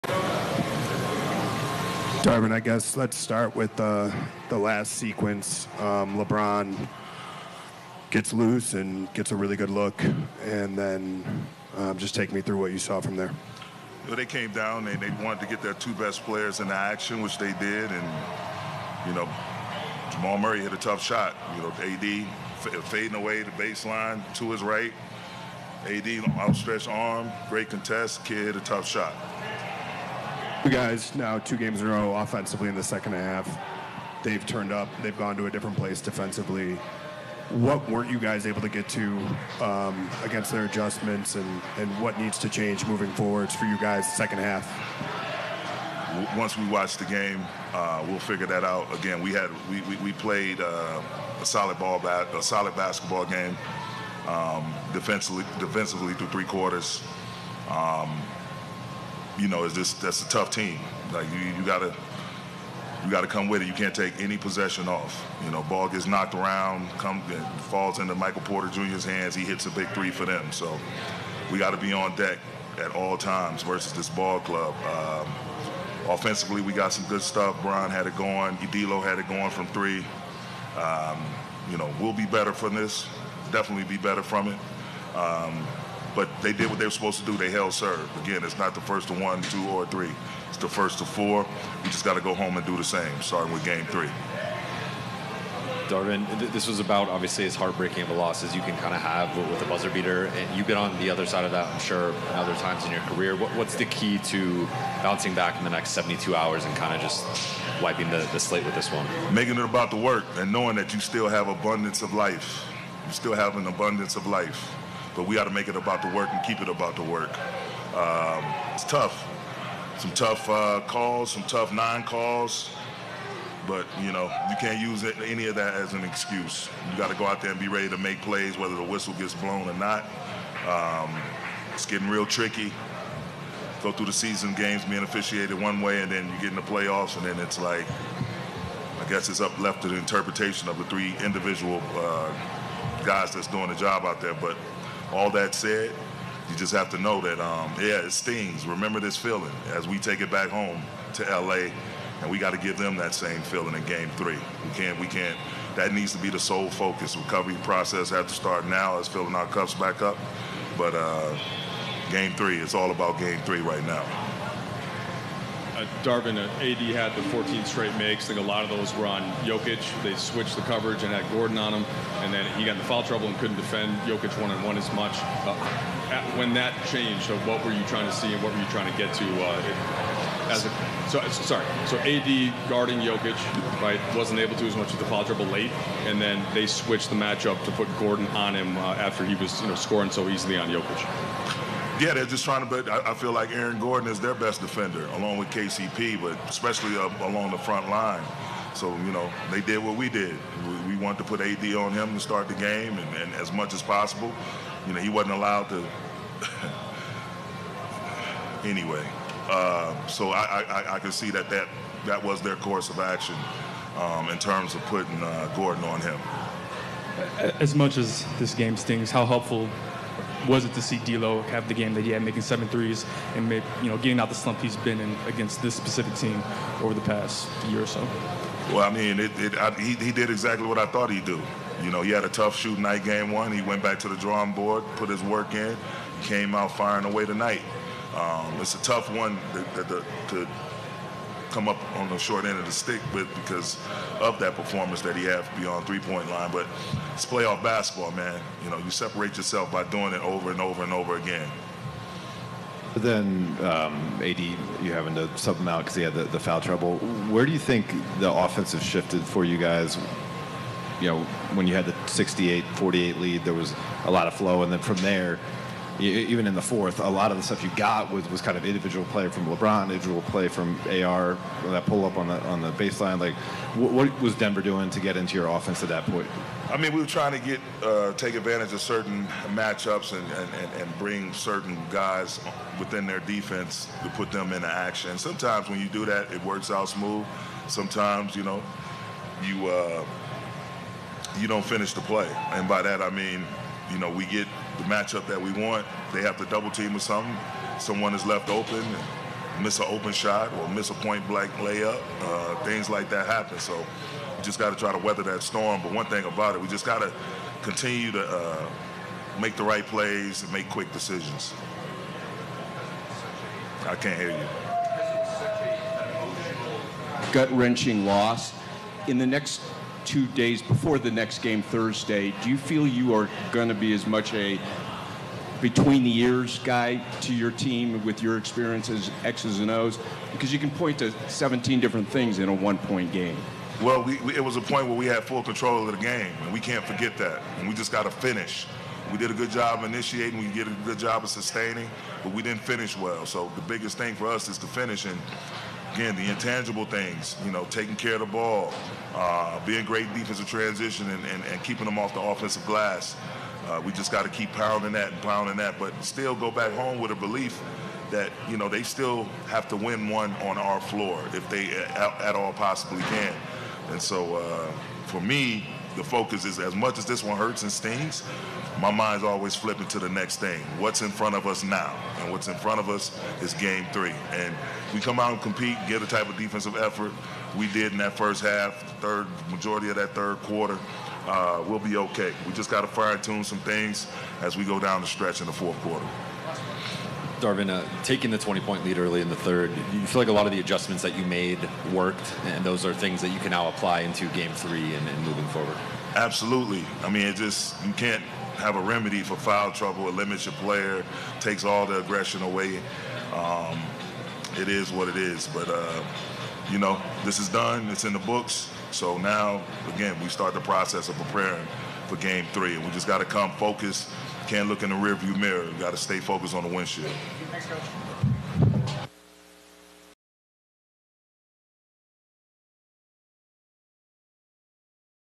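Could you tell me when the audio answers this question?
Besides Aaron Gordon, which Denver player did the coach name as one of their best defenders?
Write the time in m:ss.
3:15.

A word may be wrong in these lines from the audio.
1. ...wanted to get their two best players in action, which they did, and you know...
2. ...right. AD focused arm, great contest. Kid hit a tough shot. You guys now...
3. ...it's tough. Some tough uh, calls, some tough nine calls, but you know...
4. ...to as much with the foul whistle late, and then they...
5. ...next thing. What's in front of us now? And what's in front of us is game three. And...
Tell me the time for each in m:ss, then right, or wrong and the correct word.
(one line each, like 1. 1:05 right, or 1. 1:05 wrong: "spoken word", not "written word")
1. 0:15 right
2. 0:24 wrong: "outstretched", not "focused"
3. 1:58 right
4. 3:04 wrong: "trouble", not "whistle"
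5. 6:10 right.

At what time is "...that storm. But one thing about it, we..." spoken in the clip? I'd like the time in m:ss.
5:05.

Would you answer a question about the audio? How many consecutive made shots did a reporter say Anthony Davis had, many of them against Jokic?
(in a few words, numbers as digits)
14.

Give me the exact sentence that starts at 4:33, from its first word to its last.
Like, what, what was Denver doing to get into your offense at that point?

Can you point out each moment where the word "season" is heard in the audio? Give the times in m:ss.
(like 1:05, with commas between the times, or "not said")
2:14.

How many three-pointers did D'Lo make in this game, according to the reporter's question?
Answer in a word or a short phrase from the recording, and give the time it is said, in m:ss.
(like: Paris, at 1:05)
7, at 3:42.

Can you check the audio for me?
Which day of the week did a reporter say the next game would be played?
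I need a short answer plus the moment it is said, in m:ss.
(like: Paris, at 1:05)
Thursday, at 5:21.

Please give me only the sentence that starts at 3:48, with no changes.
Well, I mean, it, it, I, he, he did exactly what I thought he'd do.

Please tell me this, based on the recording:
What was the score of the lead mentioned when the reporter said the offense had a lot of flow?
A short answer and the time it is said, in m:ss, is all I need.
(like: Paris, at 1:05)
68-48, at 4:21.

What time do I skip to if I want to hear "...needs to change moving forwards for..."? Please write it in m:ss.
0:42.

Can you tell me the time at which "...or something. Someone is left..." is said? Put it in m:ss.
4:56.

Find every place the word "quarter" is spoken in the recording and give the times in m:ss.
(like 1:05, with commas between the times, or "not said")
0:56, 6:20, 6:25.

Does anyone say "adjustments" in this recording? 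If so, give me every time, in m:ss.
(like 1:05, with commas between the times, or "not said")
0:40, 6:30.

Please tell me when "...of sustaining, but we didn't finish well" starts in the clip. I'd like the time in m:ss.
5:41.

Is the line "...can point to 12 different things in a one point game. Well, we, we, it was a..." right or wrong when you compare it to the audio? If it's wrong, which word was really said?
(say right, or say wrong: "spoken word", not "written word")
wrong: "17", not "12".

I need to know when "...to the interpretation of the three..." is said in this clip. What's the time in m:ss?
2:19.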